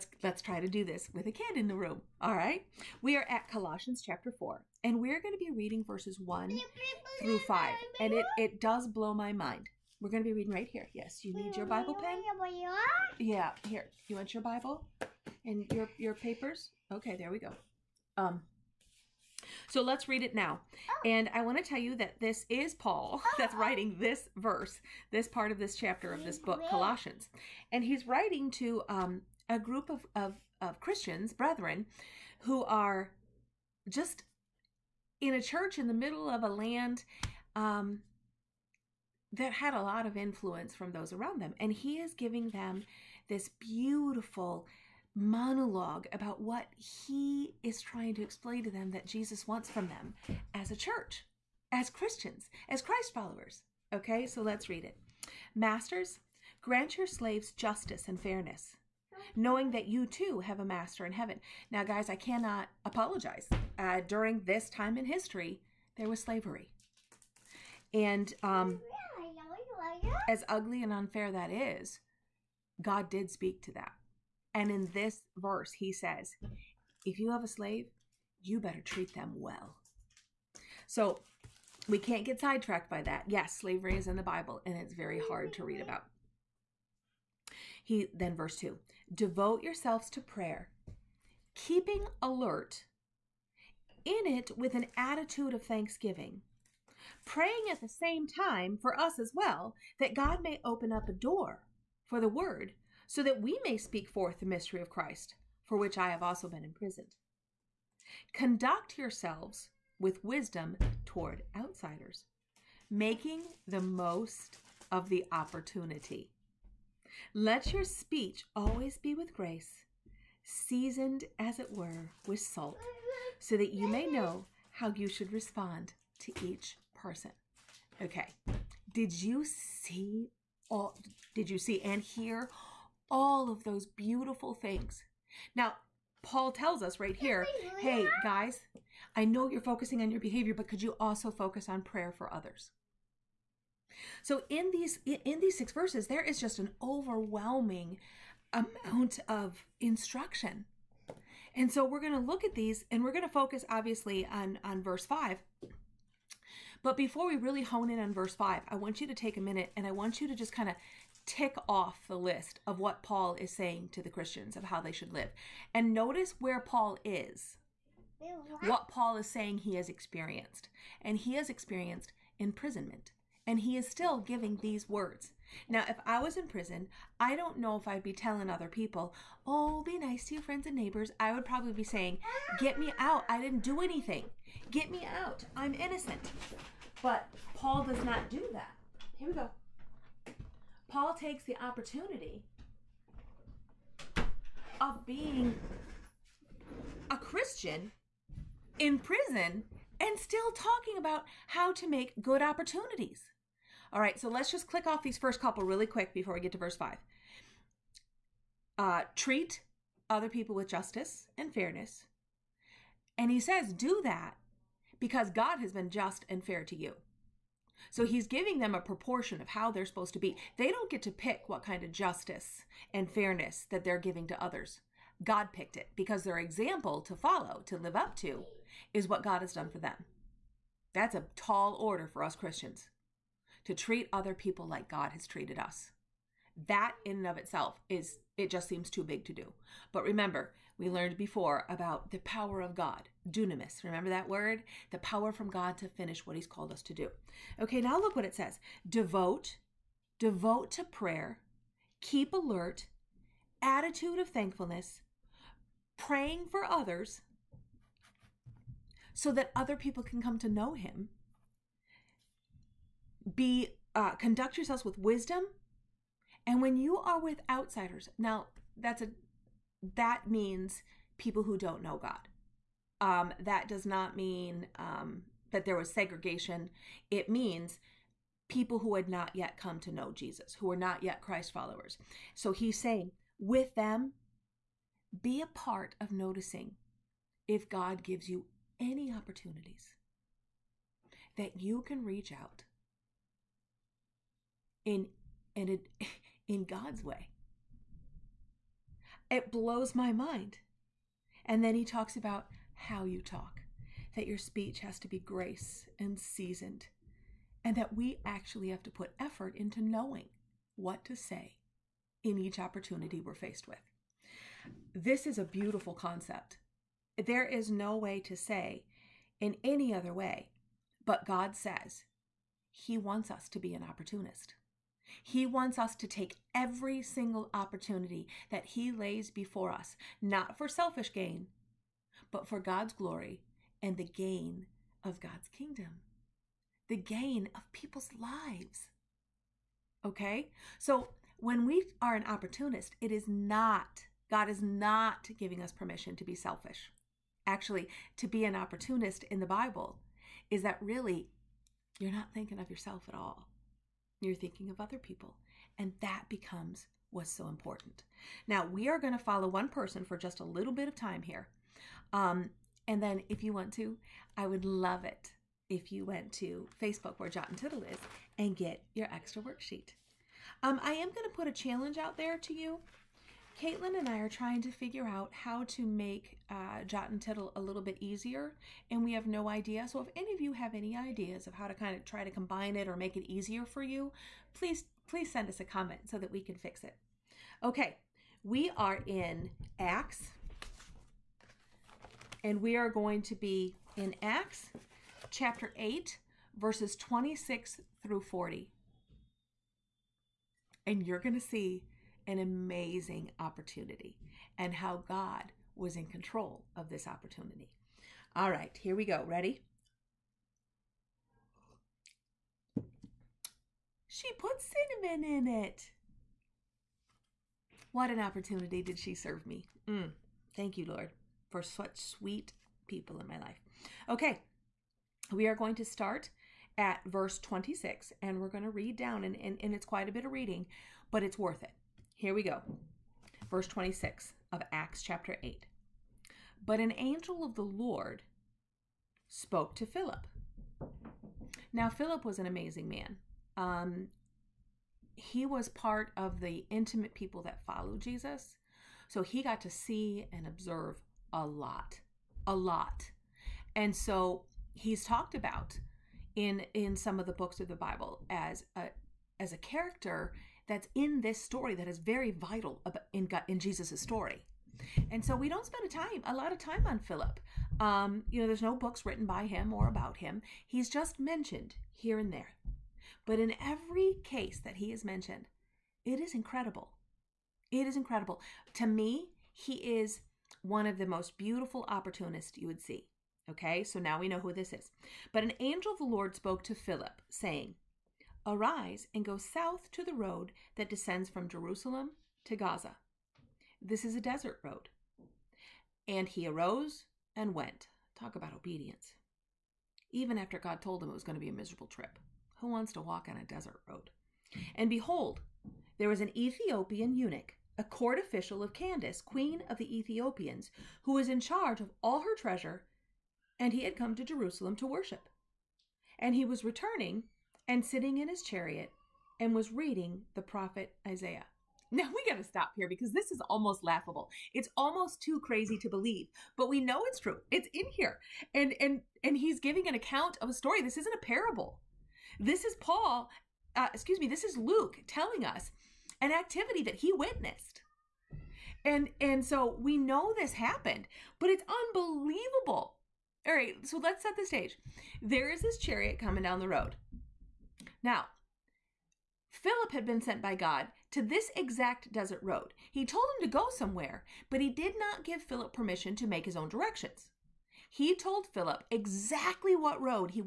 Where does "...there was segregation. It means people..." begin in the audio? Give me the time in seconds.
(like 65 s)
275 s.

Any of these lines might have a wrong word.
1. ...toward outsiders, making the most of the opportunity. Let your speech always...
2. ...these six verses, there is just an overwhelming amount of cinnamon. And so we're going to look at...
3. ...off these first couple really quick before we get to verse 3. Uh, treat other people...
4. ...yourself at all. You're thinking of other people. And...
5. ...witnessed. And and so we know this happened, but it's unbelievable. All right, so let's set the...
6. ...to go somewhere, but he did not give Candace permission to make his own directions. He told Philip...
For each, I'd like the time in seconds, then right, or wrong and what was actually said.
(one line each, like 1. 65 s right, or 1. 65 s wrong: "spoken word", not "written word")
1. 111 s right
2. 145 s wrong: "instruction", not "cinnamon"
3. 204 s wrong: "5", not "3"
4. 352 s right
5. 537 s right
6. 553 s wrong: "Philip", not "Candace".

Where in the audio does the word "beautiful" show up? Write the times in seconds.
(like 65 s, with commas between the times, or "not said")
43 s, 133 s, 315 s, 481 s.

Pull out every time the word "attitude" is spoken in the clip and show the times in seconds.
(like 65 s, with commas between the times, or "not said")
94 s, 253 s.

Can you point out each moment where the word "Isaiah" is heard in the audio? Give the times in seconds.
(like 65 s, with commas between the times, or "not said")
521 s.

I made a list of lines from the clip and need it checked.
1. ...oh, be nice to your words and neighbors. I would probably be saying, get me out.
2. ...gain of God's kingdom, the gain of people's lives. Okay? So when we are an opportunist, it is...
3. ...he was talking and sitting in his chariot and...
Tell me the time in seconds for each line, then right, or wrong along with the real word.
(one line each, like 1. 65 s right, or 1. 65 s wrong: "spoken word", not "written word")
1. 179 s wrong: "friends", not "words"
2. 334 s right
3. 516 s wrong: "returning", not "talking".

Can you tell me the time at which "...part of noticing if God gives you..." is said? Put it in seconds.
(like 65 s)
285 s.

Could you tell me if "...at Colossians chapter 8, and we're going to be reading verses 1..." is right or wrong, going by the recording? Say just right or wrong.
wrong.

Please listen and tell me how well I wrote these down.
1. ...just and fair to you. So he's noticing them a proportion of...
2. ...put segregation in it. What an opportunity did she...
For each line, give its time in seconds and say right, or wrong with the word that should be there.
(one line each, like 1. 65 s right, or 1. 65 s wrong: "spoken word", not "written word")
1. 215 s wrong: "giving", not "noticing"
2. 414 s wrong: "cinnamon", not "segregation".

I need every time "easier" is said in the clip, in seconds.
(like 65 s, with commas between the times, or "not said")
378 s, 383 s.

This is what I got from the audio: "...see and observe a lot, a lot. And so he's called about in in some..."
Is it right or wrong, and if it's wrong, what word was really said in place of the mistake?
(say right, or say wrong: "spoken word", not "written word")
wrong: "talked", not "called".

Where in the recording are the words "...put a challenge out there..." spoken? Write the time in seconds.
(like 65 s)
371 s.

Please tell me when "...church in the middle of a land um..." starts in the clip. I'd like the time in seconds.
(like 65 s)
35 s.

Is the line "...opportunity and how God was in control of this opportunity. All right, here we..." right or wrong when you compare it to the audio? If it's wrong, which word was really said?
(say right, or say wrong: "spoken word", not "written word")
right.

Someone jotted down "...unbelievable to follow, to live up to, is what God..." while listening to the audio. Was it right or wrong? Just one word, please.
wrong.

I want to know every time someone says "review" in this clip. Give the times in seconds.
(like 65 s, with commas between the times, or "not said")
not said.